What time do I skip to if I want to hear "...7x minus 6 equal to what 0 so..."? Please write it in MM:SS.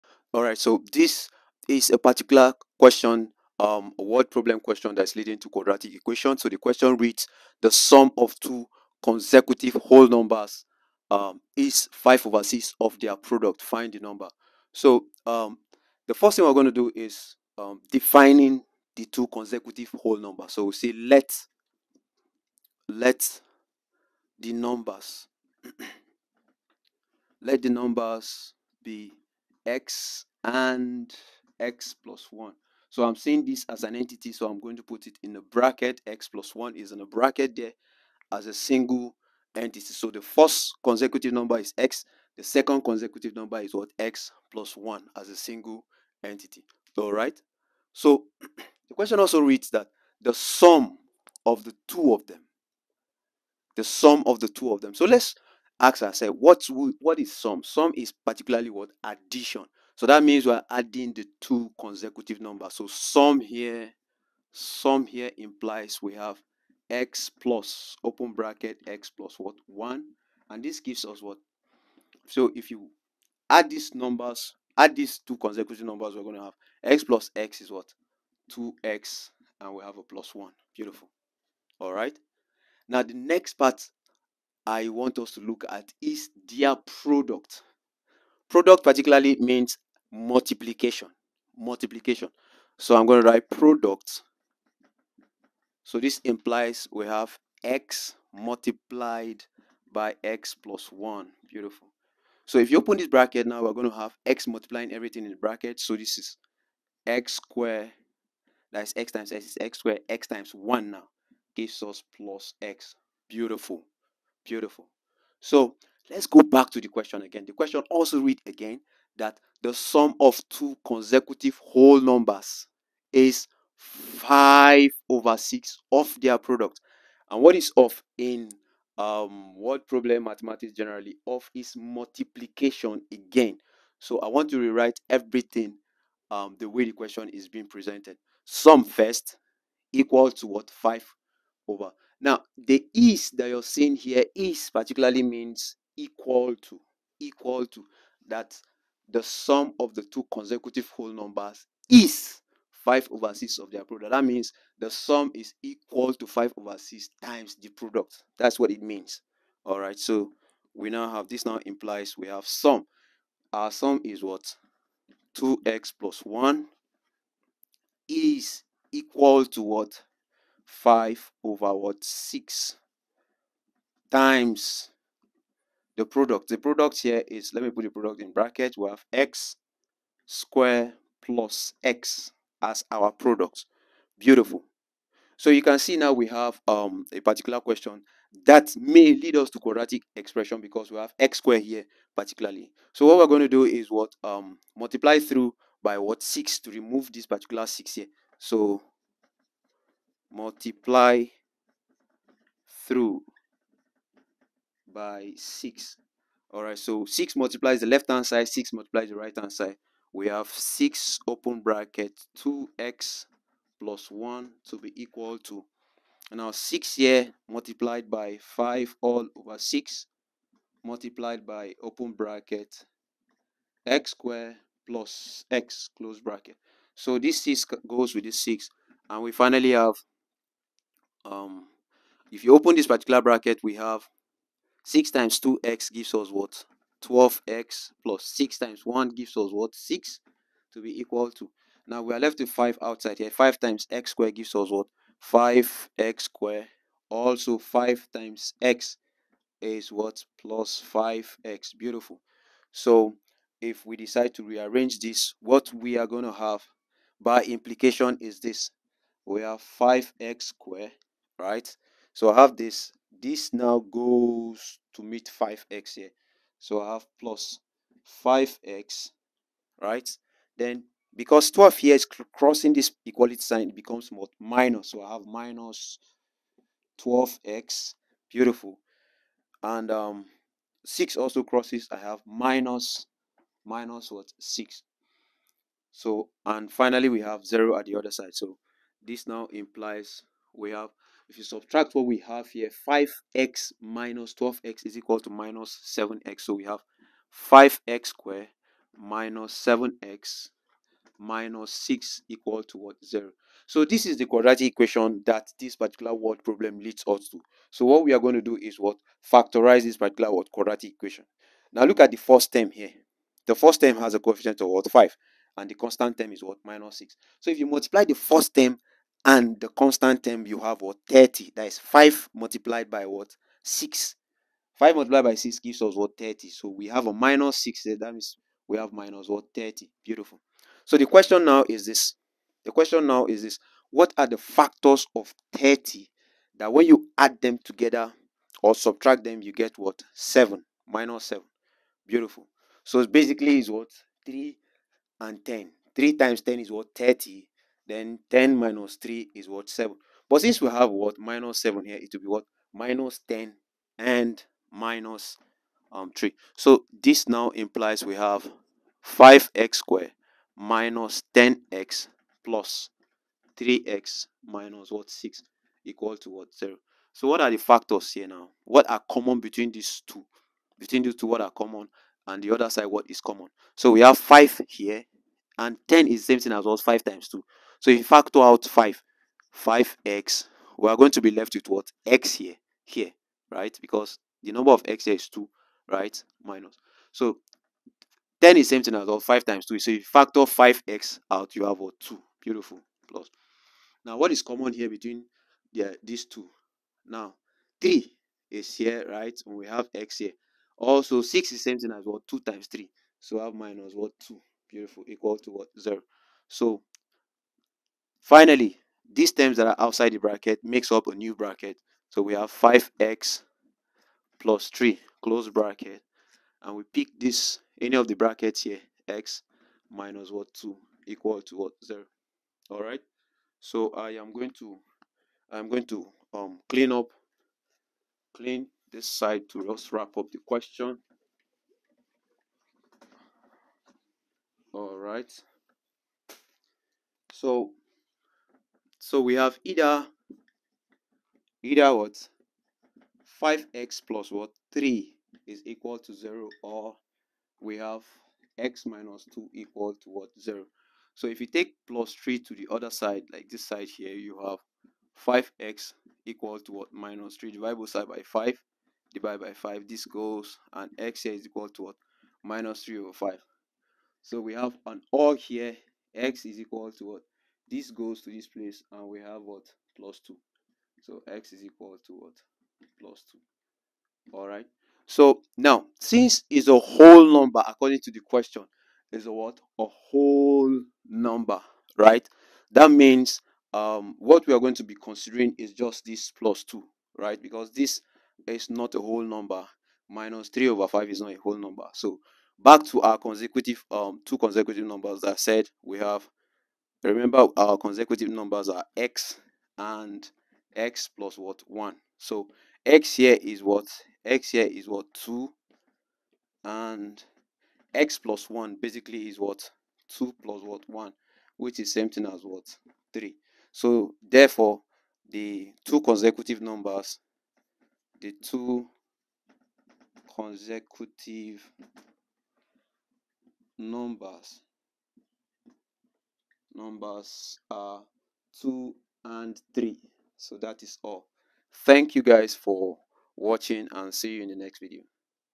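04:59.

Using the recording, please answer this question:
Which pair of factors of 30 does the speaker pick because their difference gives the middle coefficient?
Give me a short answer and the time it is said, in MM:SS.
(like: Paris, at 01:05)
3 and 10, at 05:44.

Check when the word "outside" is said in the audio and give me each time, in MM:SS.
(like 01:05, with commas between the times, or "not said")
04:02, 06:49.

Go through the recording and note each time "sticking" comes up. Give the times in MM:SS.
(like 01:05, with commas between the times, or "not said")
not said.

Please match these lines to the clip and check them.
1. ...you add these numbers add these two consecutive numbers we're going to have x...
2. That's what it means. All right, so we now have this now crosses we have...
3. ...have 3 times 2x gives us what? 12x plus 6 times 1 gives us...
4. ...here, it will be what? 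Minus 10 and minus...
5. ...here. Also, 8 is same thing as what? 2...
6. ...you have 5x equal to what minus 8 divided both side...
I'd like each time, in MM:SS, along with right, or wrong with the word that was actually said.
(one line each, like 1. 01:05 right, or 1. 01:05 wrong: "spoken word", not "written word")
1. 01:12 right
2. 02:38 wrong: "implies", not "crosses"
3. 03:53 wrong: "6", not "3"
4. 05:51 right
5. 06:40 wrong: "6", not "8"
6. 07:34 wrong: "3", not "8".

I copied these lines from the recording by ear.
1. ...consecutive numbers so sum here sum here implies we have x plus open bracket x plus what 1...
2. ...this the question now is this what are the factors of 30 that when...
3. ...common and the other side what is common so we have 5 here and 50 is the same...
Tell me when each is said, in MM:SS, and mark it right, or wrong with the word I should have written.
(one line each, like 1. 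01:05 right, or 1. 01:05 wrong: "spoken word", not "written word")
1. 01:01 right
2. 05:31 right
3. 06:11 wrong: "10", not "50".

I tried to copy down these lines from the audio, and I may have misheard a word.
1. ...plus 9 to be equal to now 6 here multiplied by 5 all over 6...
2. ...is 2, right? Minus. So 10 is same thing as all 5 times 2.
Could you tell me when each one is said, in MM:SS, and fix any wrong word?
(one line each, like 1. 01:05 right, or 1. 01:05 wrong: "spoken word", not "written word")
1. 03:33 wrong: "1", not "9"
2. 06:25 right.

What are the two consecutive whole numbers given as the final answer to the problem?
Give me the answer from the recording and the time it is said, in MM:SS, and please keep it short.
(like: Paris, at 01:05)
2 and 3, at 08:48.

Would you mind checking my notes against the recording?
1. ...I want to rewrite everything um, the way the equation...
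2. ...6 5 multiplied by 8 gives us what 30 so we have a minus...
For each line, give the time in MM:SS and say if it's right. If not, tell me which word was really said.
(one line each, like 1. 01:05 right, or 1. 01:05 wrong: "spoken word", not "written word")
1. 02:14 wrong: "question", not "equation"
2. 05:23 wrong: "6", not "8".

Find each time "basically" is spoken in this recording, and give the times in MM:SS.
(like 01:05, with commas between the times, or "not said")
05:43, 08:28.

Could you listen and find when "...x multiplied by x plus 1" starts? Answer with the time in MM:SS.
01:37.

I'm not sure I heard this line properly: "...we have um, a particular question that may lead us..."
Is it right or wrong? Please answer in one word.
right.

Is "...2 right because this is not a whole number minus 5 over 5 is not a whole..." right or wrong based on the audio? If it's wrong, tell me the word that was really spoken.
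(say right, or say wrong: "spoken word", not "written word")
wrong: "3", not "5".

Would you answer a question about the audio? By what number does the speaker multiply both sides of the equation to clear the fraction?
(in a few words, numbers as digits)
6.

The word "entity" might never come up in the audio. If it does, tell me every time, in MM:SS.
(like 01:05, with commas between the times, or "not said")
00:33, 00:39, 00:46.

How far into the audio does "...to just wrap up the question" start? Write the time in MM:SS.
07:09.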